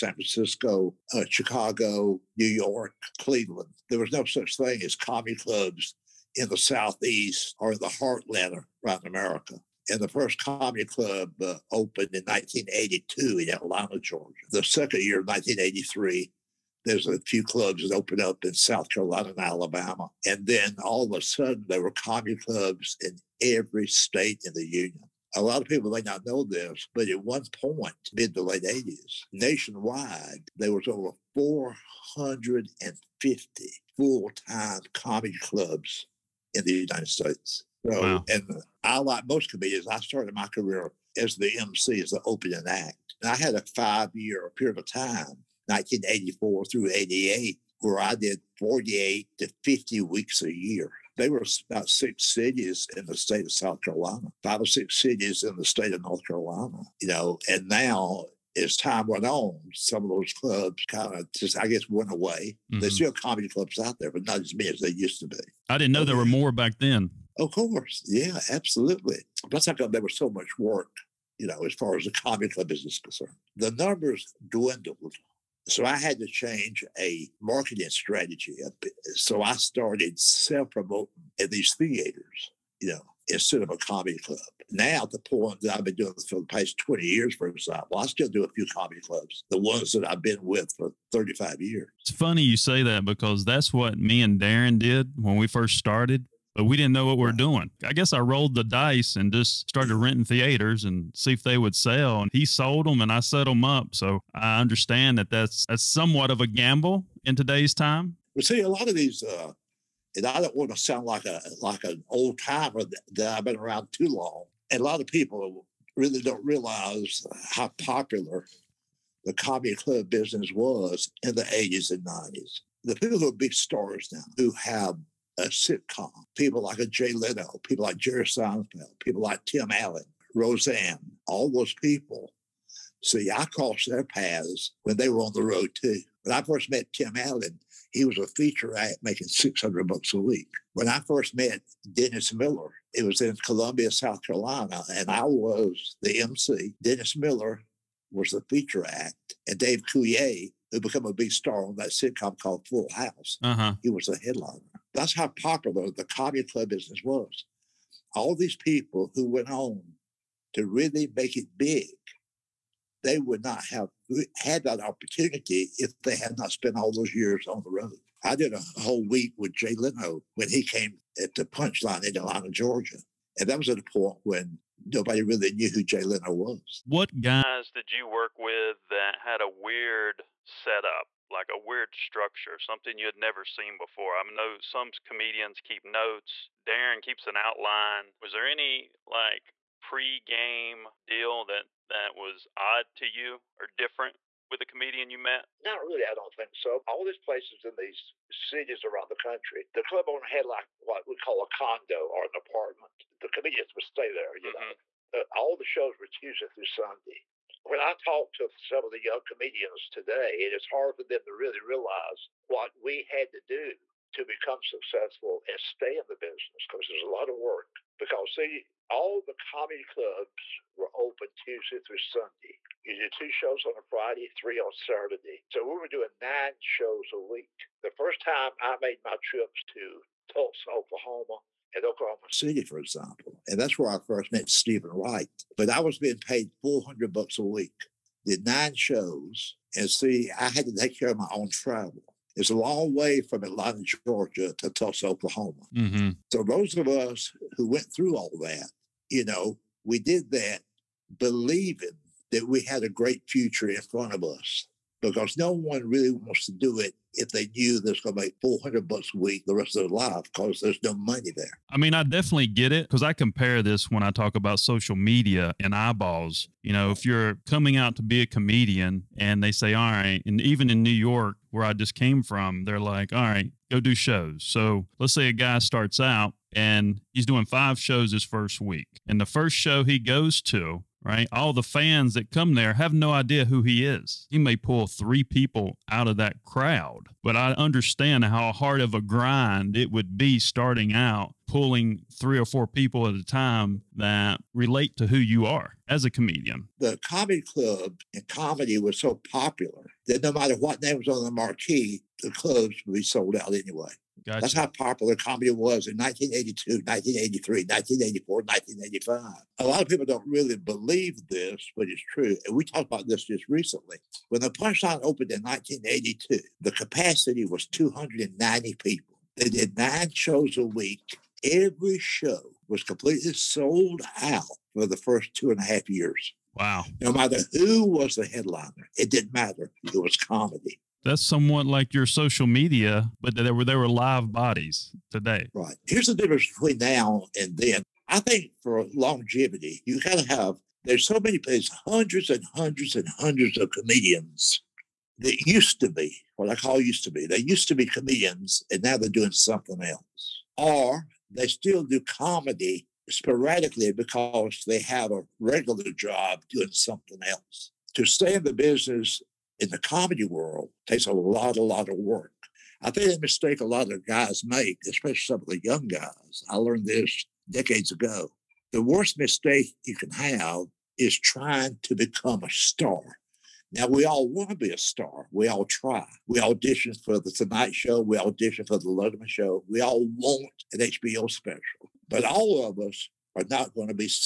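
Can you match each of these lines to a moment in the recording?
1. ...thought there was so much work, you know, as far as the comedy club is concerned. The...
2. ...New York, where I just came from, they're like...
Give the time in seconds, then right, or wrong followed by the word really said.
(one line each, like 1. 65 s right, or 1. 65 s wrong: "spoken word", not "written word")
1. 69 s right
2. 270 s right.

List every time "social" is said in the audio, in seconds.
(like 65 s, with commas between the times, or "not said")
264 s, 332 s.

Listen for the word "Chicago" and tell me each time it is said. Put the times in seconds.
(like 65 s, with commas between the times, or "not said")
1 s.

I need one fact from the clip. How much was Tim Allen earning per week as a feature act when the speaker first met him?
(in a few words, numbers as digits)
$600.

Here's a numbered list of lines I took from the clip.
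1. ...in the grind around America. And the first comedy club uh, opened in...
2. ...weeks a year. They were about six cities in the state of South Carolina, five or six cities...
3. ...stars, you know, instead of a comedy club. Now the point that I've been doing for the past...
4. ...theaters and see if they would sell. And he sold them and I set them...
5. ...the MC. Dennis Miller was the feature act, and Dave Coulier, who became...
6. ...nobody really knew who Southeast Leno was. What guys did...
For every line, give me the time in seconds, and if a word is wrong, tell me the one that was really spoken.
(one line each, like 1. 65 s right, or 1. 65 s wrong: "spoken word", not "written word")
1. 7 s wrong: "heartland", not "grind"
2. 50 s right
3. 81 s wrong: "theaters", not "stars"
4. 100 s right
5. 146 s right
6. 174 s wrong: "Jay", not "Southeast".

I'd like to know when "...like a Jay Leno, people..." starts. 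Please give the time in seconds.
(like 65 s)
126 s.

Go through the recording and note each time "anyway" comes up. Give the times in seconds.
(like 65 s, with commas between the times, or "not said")
303 s.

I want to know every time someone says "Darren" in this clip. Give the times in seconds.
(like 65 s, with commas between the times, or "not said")
94 s, 186 s.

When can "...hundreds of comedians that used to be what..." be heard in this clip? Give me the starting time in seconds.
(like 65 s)
343 s.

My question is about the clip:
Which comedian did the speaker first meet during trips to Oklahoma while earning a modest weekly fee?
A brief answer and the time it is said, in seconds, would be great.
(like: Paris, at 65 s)
Steven Wright, at 234 s.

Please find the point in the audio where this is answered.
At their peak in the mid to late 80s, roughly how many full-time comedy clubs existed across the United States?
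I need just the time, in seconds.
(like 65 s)
30 s.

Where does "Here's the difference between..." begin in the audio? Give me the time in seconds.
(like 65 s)
335 s.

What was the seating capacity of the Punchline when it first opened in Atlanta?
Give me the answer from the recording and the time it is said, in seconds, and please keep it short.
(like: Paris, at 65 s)
290, at 317 s.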